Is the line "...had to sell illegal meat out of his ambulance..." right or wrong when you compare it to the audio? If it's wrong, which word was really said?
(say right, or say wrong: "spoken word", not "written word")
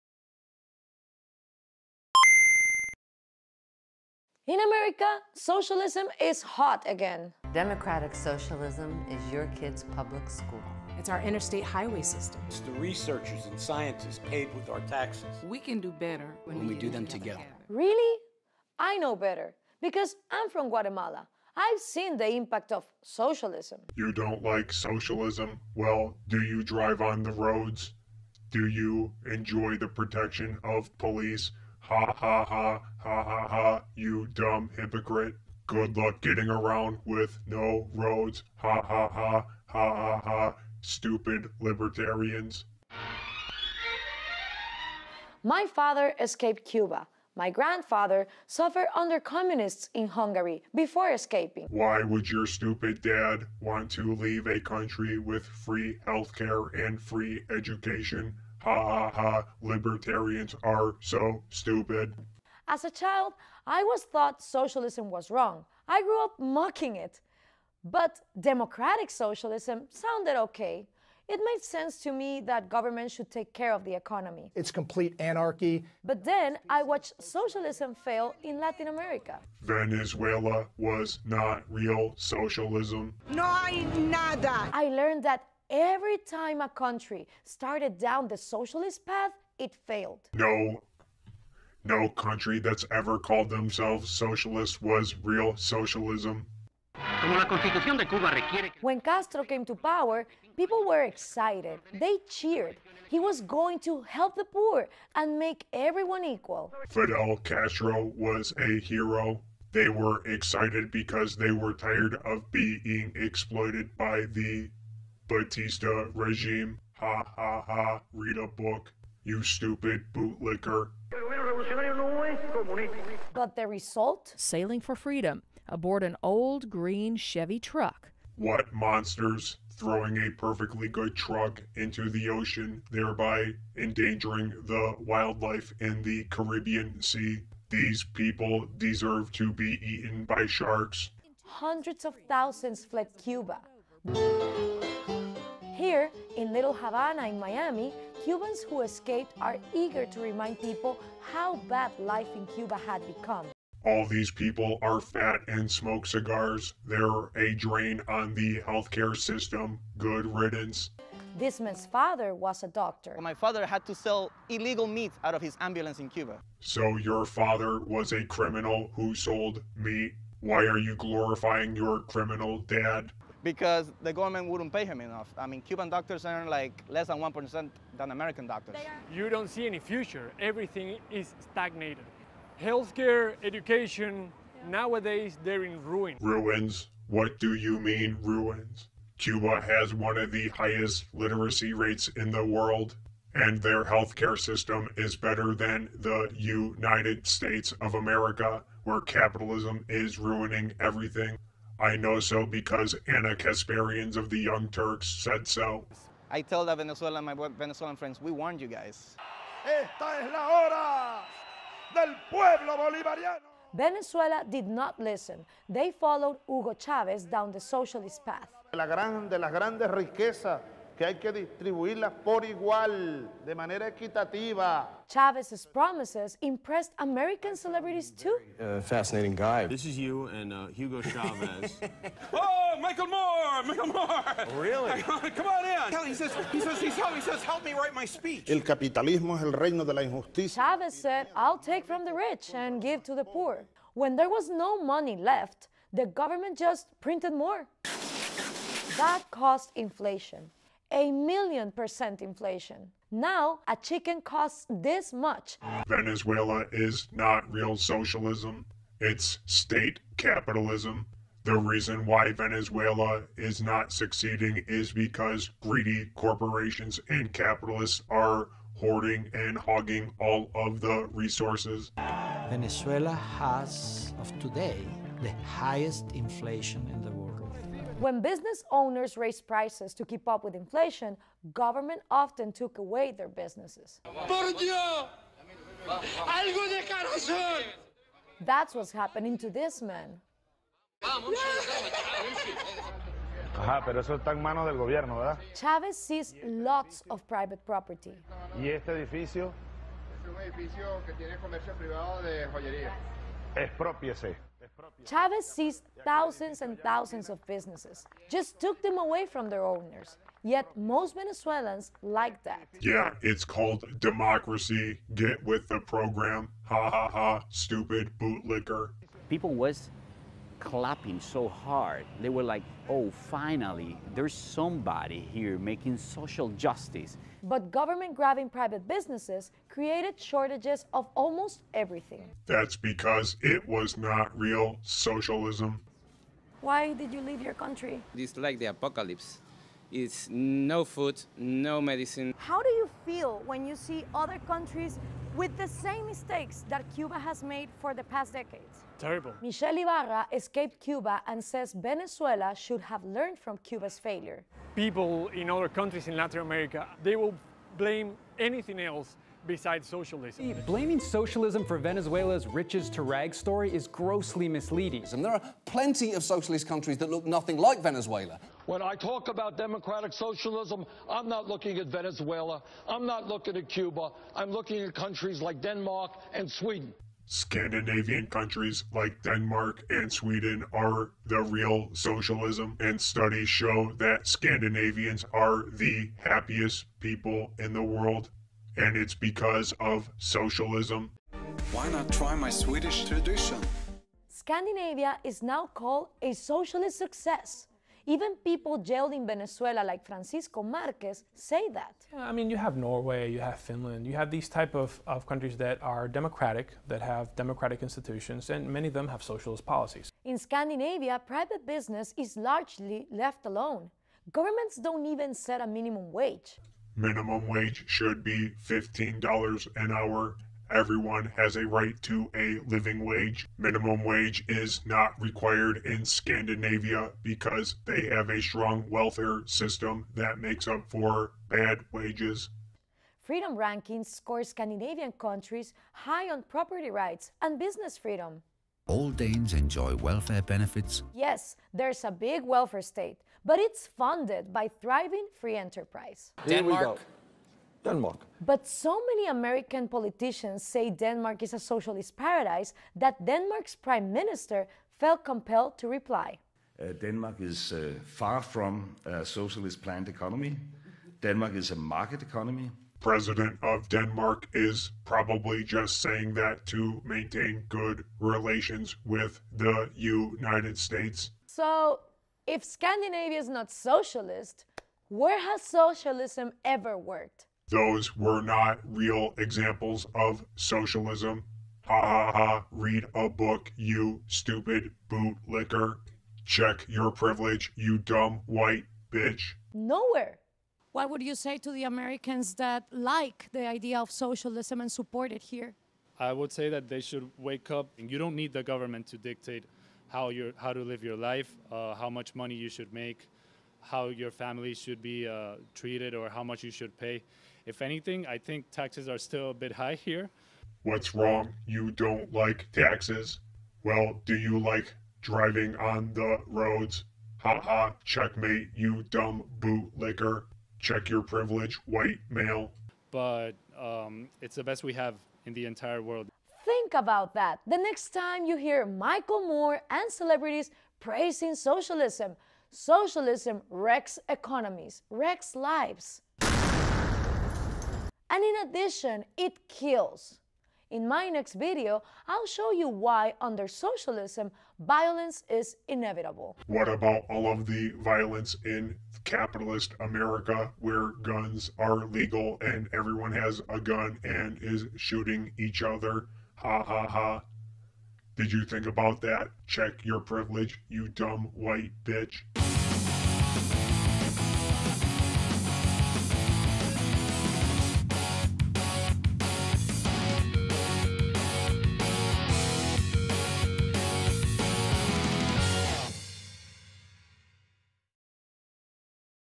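right.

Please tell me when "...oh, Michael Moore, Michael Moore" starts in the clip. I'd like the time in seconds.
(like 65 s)
232 s.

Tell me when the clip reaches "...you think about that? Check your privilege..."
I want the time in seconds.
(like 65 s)
558 s.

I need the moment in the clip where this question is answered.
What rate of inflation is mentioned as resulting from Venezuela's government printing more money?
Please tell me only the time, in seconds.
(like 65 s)
250 s.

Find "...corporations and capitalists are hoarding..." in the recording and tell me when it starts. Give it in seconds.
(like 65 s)
266 s.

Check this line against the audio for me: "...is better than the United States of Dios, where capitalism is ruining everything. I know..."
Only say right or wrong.
wrong.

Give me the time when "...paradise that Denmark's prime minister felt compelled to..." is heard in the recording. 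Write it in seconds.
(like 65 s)
452 s.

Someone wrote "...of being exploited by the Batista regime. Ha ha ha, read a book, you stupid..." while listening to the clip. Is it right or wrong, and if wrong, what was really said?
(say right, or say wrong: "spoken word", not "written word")
right.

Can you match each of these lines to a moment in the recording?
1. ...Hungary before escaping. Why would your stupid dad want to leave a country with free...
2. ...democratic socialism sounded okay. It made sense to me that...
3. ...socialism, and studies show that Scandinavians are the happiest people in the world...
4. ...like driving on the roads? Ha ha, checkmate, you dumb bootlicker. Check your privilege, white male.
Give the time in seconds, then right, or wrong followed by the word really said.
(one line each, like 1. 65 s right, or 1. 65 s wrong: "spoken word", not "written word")
1. 50 s right
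2. 68 s right
3. 381 s right
4. 514 s right.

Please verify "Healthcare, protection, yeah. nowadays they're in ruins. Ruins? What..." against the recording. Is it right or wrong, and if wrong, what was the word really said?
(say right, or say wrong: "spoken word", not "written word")
wrong: "education", not "protection".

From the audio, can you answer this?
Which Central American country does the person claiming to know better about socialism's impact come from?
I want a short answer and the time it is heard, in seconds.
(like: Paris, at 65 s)
Guatemala, at 20 s.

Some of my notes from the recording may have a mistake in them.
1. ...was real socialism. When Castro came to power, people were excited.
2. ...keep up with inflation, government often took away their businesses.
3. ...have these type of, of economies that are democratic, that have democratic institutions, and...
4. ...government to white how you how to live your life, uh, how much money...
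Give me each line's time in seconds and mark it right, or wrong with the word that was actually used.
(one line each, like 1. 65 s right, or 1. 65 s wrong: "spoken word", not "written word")
1. 94 s right
2. 280 s right
3. 404 s wrong: "countries", not "economies"
4. 498 s wrong: "dictate", not "white".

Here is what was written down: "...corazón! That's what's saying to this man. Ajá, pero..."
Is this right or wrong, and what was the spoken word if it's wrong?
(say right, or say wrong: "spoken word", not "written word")
wrong: "happening", not "saying".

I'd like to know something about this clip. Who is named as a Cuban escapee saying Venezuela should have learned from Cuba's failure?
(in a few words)
Michelle Ibarra.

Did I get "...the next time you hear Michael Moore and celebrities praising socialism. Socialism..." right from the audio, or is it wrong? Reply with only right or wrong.
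right.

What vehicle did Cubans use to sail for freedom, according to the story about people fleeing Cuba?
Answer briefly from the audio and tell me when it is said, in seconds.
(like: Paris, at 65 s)
an old green Chevy truck, at 126 s.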